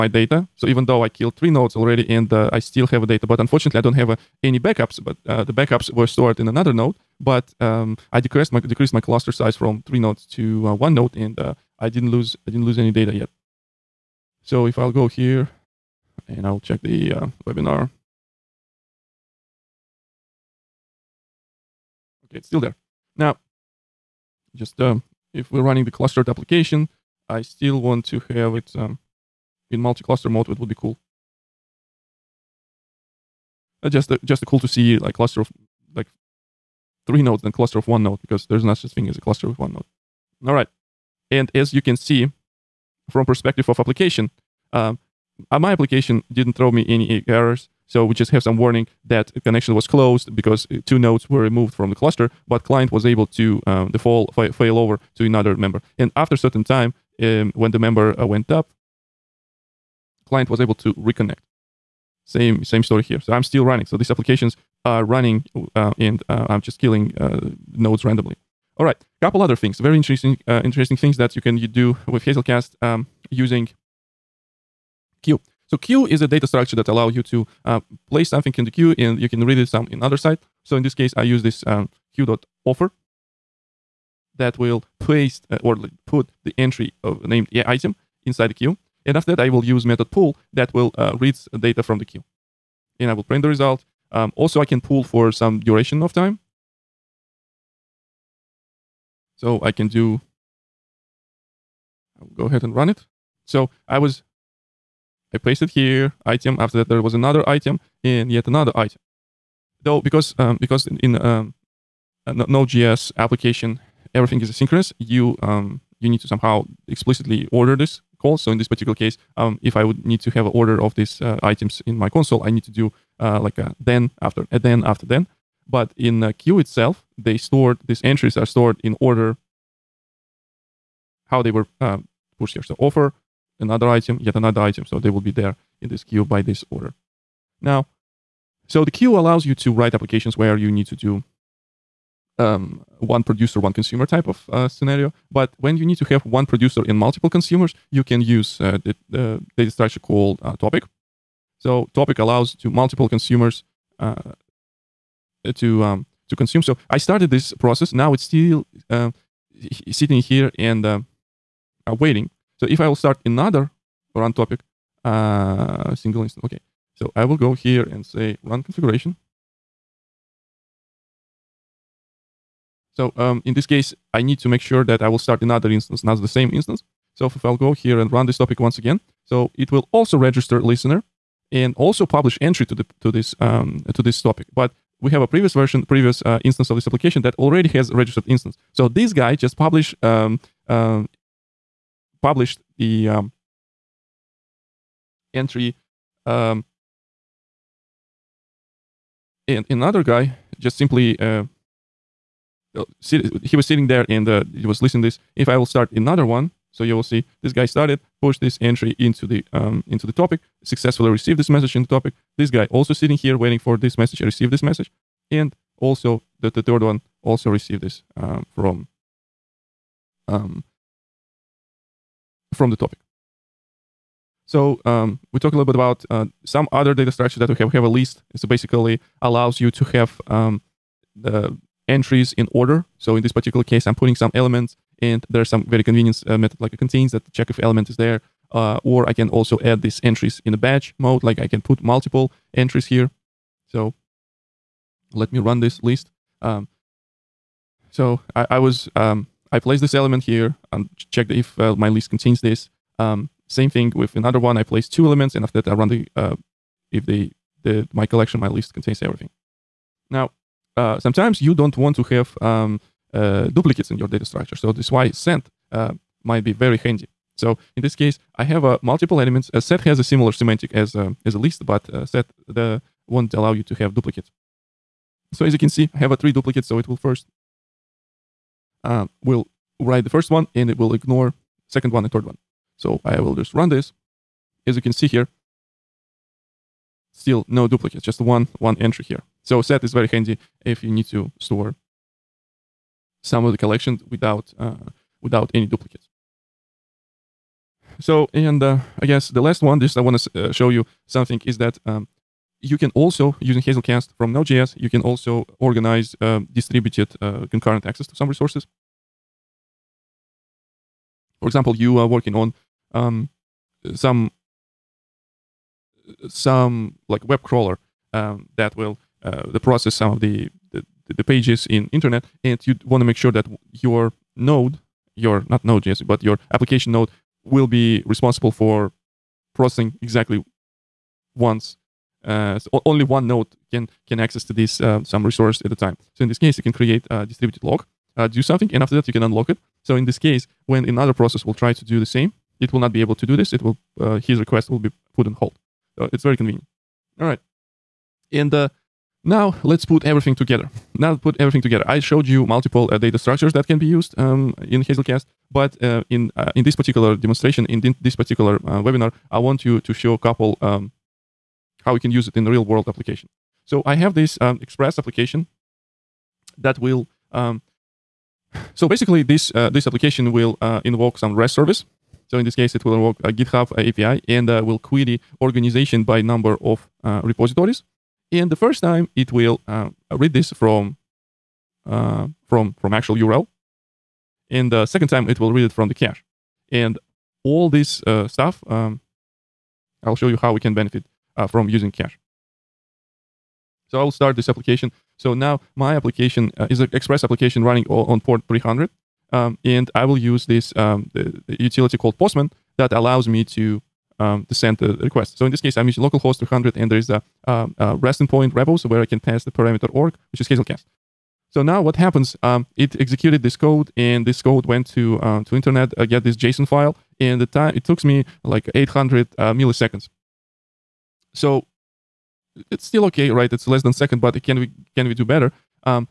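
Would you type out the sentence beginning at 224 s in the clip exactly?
So um, we talk a little bit about uh, some other data structures that we have.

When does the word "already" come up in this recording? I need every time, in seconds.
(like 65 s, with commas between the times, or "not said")
1 s, 187 s.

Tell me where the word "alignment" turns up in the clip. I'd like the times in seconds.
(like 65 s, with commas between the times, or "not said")
not said.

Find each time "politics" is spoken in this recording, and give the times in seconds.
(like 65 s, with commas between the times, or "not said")
not said.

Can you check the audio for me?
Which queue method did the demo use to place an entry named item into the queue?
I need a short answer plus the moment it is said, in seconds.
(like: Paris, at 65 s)
offer, at 82 s.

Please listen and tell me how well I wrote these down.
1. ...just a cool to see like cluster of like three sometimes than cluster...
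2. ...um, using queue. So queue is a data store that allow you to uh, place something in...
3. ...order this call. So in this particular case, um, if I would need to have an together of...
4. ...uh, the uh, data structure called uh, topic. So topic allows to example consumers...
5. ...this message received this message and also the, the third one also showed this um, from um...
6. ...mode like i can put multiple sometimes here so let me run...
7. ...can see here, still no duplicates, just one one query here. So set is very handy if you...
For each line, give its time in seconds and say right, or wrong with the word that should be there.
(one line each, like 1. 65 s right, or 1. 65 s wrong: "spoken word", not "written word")
1. 34 s wrong: "nodes", not "sometimes"
2. 72 s wrong: "structure", not "store"
3. 117 s wrong: "order", not "together"
4. 148 s wrong: "multiple", not "example"
5. 213 s wrong: "received", not "showed"
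6. 240 s wrong: "entries", not "sometimes"
7. 284 s wrong: "entry", not "query".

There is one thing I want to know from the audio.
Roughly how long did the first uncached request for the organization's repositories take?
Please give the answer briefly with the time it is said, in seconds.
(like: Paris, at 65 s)
800 milliseconds, at 418 s.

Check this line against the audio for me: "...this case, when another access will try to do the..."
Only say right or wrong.
wrong.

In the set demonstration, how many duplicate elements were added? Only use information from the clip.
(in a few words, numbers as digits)
3.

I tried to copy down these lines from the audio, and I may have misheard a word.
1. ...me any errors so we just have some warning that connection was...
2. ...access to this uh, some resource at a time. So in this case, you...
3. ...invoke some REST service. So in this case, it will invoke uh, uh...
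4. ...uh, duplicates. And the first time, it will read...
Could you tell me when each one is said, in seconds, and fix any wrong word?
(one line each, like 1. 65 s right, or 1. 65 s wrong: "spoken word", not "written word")
1. 46 s right
2. 334 s right
3. 370 s right
4. 377 s wrong: "repositories", not "duplicates".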